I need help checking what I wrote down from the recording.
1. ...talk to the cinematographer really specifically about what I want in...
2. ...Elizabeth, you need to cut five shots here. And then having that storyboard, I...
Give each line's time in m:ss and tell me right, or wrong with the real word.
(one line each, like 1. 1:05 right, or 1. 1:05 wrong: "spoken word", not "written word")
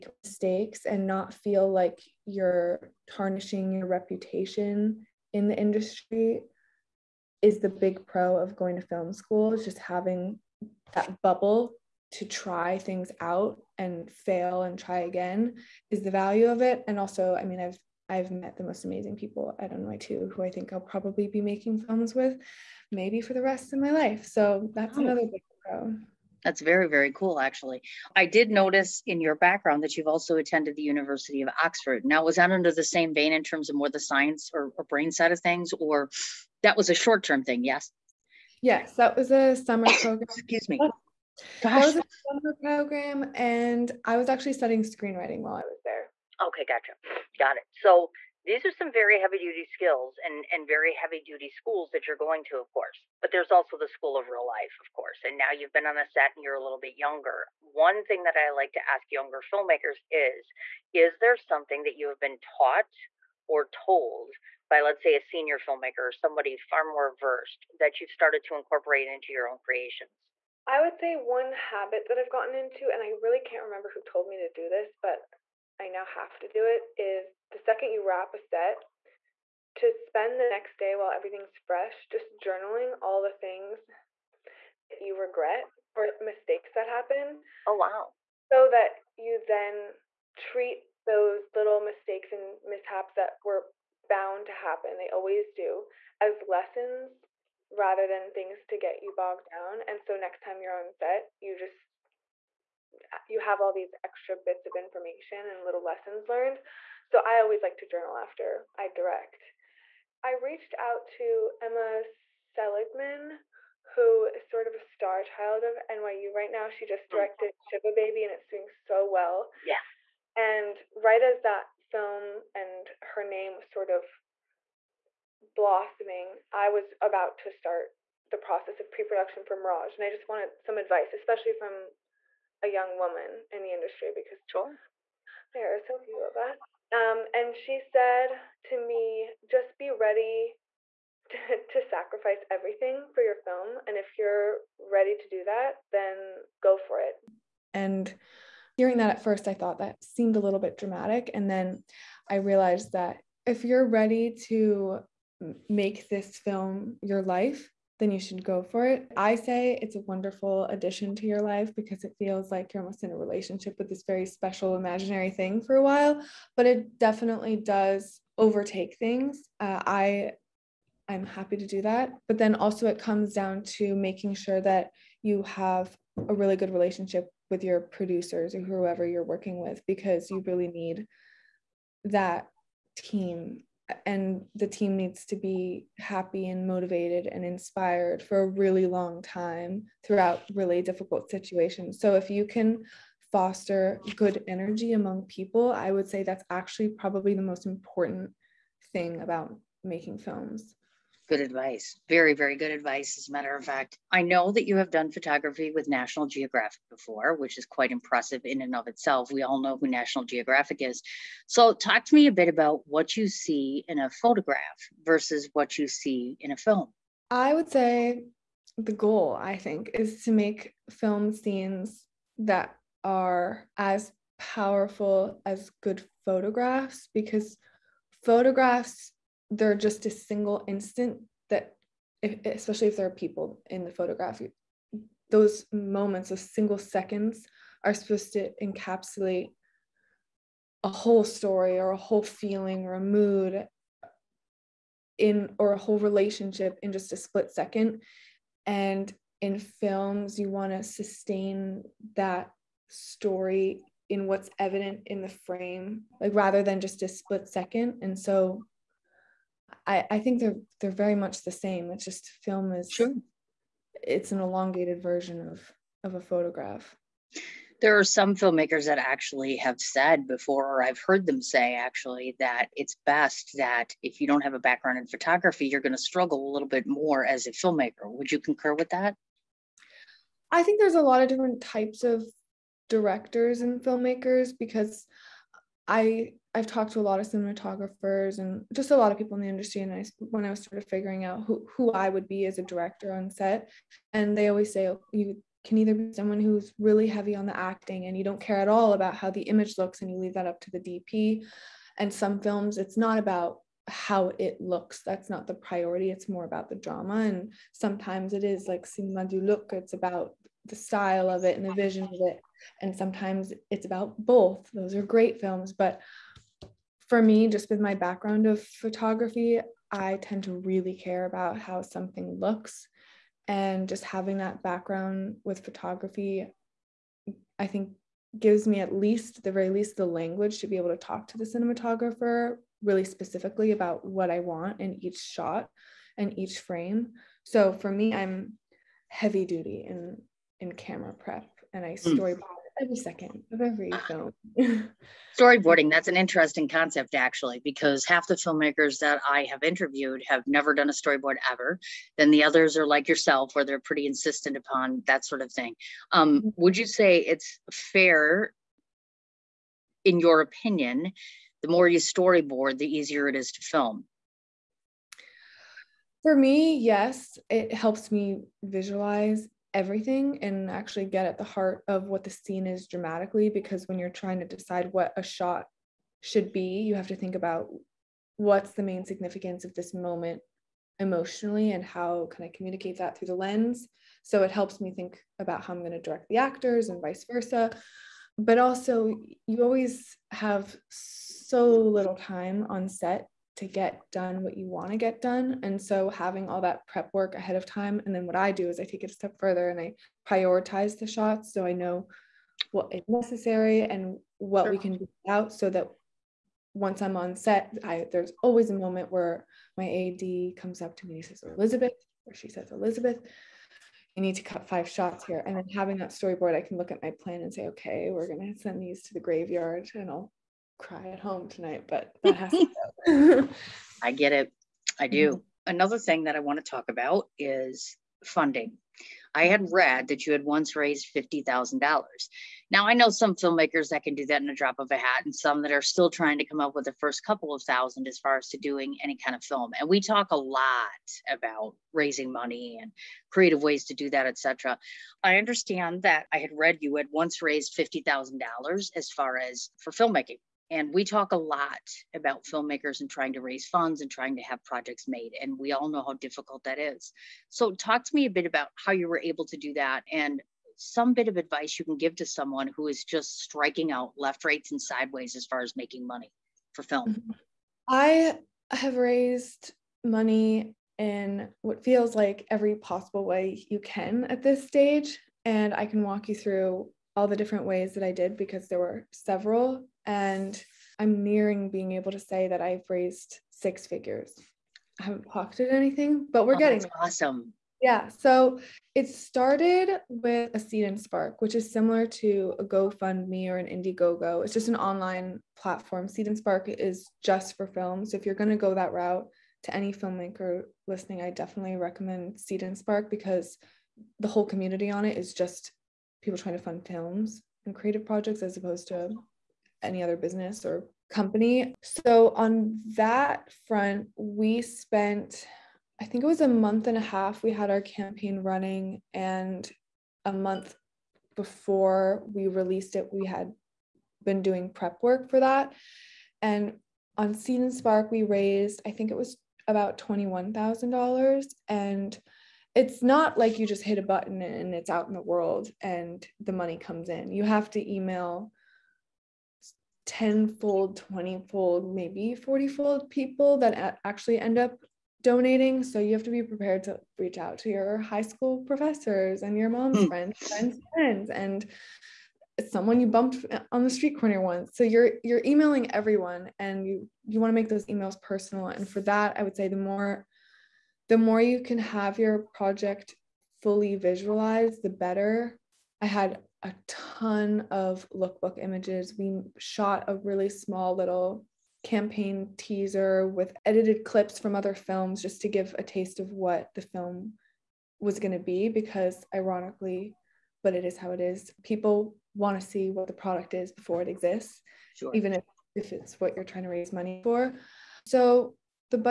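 1. 5:30 right
2. 6:52 right.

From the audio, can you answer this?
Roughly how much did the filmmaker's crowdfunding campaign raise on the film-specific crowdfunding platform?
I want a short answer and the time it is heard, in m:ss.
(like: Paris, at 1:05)
$21,000, at 8:49.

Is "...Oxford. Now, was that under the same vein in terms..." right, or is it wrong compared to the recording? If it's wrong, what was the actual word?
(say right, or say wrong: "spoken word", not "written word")
right.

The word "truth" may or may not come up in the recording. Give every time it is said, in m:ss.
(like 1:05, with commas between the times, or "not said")
not said.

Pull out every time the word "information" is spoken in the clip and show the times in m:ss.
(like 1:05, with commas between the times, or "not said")
1:44.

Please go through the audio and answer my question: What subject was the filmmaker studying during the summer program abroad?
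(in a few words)
Screenwriting.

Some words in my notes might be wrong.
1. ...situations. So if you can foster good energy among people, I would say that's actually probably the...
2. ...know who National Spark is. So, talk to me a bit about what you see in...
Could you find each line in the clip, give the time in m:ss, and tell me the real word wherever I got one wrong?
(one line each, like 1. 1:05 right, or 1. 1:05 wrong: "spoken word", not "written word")
1. 3:11 right
2. 3:29 wrong: "Geographic", not "Spark".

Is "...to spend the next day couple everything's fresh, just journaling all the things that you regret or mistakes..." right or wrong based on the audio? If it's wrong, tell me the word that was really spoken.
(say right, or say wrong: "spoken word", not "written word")
wrong: "while", not "couple".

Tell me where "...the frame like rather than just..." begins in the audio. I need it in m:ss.
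4:15.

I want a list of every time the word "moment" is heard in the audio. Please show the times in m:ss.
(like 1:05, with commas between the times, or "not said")
3:55, 6:19, 6:48.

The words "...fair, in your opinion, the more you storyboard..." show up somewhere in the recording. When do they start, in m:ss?
5:57.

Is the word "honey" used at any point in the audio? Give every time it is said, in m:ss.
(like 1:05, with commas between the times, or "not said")
not said.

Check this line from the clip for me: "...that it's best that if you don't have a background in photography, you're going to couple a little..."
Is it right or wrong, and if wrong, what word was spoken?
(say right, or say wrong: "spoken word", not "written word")
wrong: "struggle", not "couple".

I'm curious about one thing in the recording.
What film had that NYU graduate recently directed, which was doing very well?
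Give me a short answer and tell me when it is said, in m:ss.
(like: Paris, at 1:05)
Shiva Baby, at 1:57.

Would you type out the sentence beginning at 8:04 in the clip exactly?
I haven't pocketed anything, but we're oh, getting awesome.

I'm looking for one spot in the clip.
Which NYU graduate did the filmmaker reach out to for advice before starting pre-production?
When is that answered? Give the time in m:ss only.
1:51.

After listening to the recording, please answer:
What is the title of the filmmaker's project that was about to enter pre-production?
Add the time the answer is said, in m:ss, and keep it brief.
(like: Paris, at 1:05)
Mirage, at 2:09.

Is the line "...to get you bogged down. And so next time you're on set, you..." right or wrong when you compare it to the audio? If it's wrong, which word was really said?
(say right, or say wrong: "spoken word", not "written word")
right.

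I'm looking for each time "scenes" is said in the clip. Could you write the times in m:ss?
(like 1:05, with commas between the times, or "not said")
3:41, 6:12.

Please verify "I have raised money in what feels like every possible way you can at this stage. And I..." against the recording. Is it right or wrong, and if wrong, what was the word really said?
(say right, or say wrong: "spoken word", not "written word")
right.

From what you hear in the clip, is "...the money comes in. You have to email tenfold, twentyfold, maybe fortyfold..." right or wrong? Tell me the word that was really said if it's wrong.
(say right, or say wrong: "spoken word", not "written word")
right.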